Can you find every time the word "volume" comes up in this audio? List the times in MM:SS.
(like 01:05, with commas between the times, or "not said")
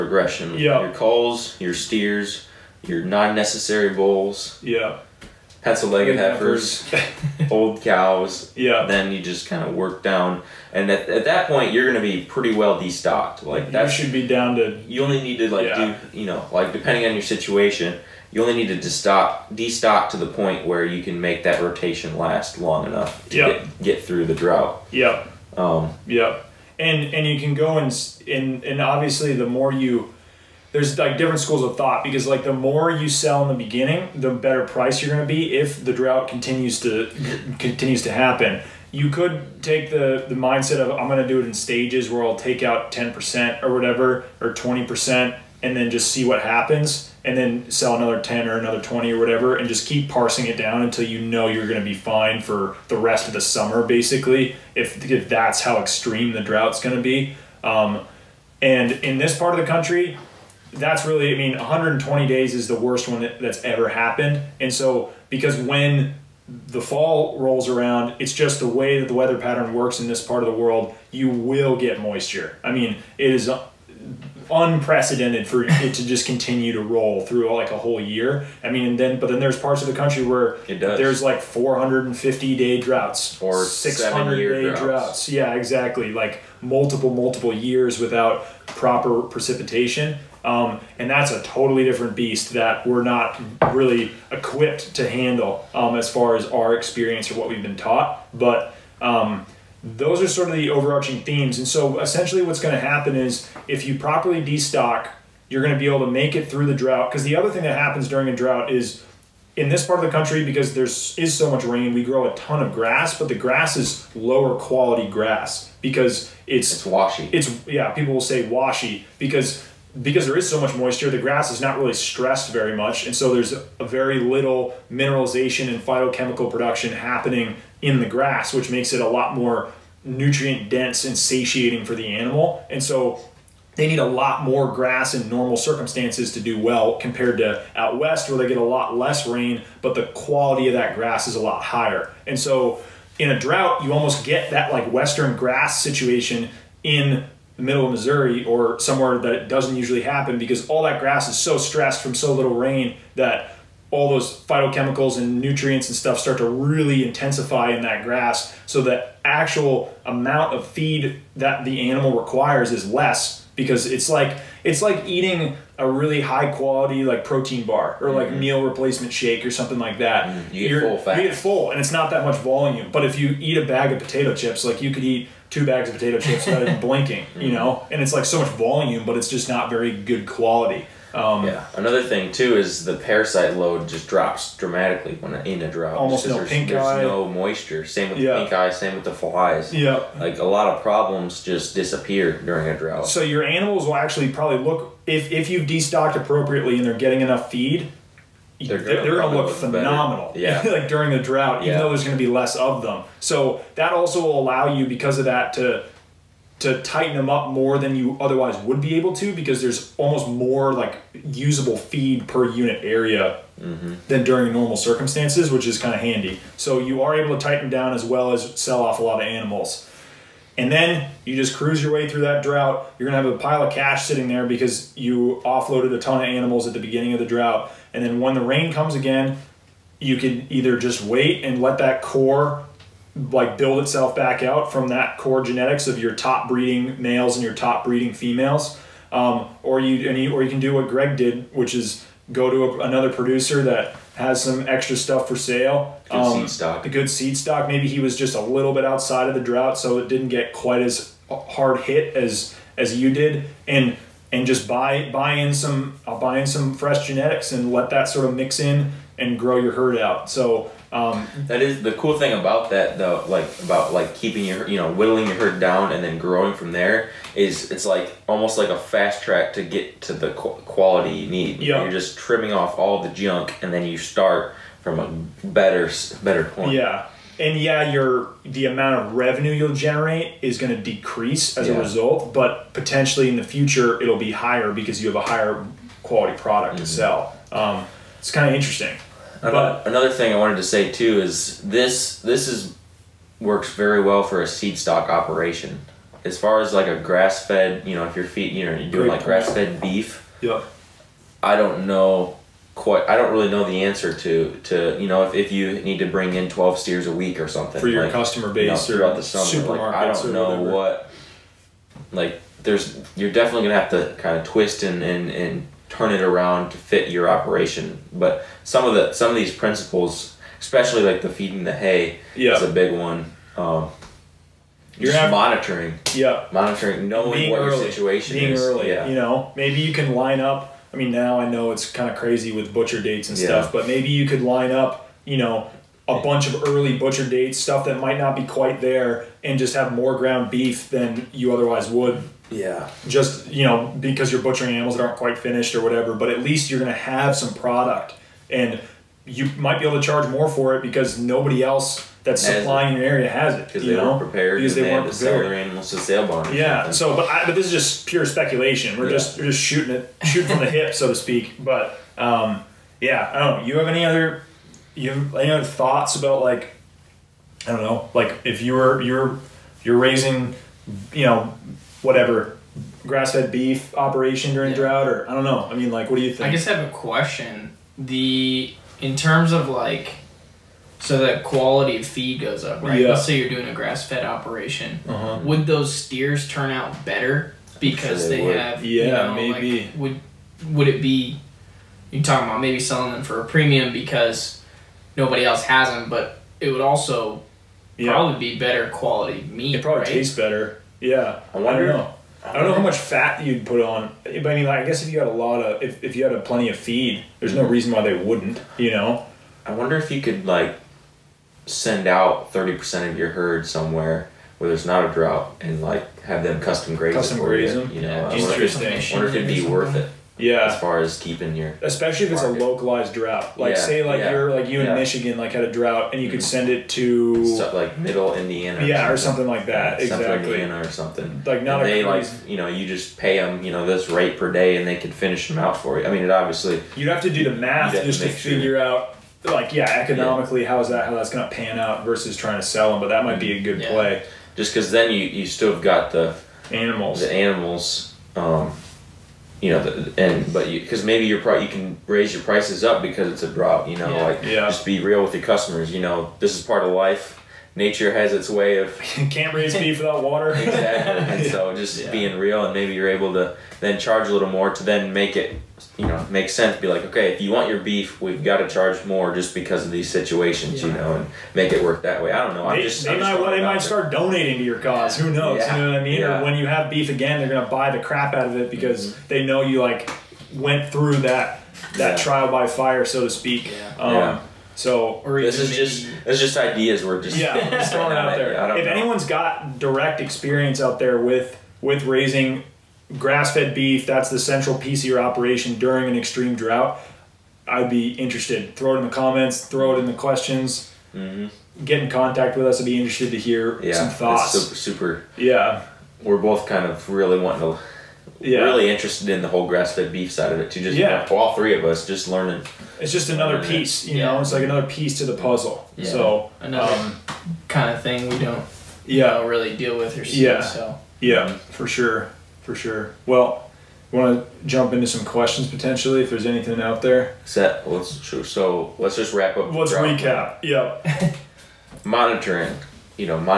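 02:52, 02:58.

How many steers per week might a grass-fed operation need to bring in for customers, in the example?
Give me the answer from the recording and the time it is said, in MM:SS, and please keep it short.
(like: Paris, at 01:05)
12, at 05:06.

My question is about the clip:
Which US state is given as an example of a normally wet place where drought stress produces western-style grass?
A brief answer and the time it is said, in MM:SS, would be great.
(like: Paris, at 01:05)
Missouri, at 02:27.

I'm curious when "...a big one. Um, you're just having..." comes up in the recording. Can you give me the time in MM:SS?
05:22.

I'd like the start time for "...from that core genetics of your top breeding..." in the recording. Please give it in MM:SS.
03:54.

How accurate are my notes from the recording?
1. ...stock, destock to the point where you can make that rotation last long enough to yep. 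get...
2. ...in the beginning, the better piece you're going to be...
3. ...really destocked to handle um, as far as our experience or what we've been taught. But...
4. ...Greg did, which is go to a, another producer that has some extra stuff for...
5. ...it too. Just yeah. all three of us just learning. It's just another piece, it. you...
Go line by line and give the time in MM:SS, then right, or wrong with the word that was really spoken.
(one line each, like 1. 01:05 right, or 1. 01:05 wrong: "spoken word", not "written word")
1. 00:18 wrong: "destock", not "stock"
2. 00:33 wrong: "price", not "piece"
3. 01:33 wrong: "equipped", not "destocked"
4. 04:00 right
5. 08:30 right.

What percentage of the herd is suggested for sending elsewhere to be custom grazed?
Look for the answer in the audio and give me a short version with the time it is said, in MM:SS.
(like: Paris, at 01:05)
30%, at 06:52.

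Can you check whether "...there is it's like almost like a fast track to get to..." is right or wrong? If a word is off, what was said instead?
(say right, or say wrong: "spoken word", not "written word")
right.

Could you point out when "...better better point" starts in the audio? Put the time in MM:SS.
04:35.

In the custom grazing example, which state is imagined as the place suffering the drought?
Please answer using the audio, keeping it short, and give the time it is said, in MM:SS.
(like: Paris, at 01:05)
Michigan, at 07:04.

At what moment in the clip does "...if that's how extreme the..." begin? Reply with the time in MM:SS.
00:55.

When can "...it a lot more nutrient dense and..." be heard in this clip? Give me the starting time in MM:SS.
02:08.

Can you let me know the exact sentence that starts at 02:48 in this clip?
meal replacement shake or something like that.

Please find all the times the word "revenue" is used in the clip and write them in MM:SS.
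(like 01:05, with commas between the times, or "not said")
04:39.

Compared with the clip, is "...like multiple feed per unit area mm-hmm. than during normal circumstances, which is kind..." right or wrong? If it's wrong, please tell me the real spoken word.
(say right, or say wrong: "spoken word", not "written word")
wrong: "usable", not "multiple".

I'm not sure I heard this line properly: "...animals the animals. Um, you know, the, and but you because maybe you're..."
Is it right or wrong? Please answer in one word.
right.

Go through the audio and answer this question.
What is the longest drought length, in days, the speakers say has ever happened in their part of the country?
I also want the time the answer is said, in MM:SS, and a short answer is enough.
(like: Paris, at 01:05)
120 days, at 01:01.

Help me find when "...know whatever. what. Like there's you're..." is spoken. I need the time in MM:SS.
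05:10.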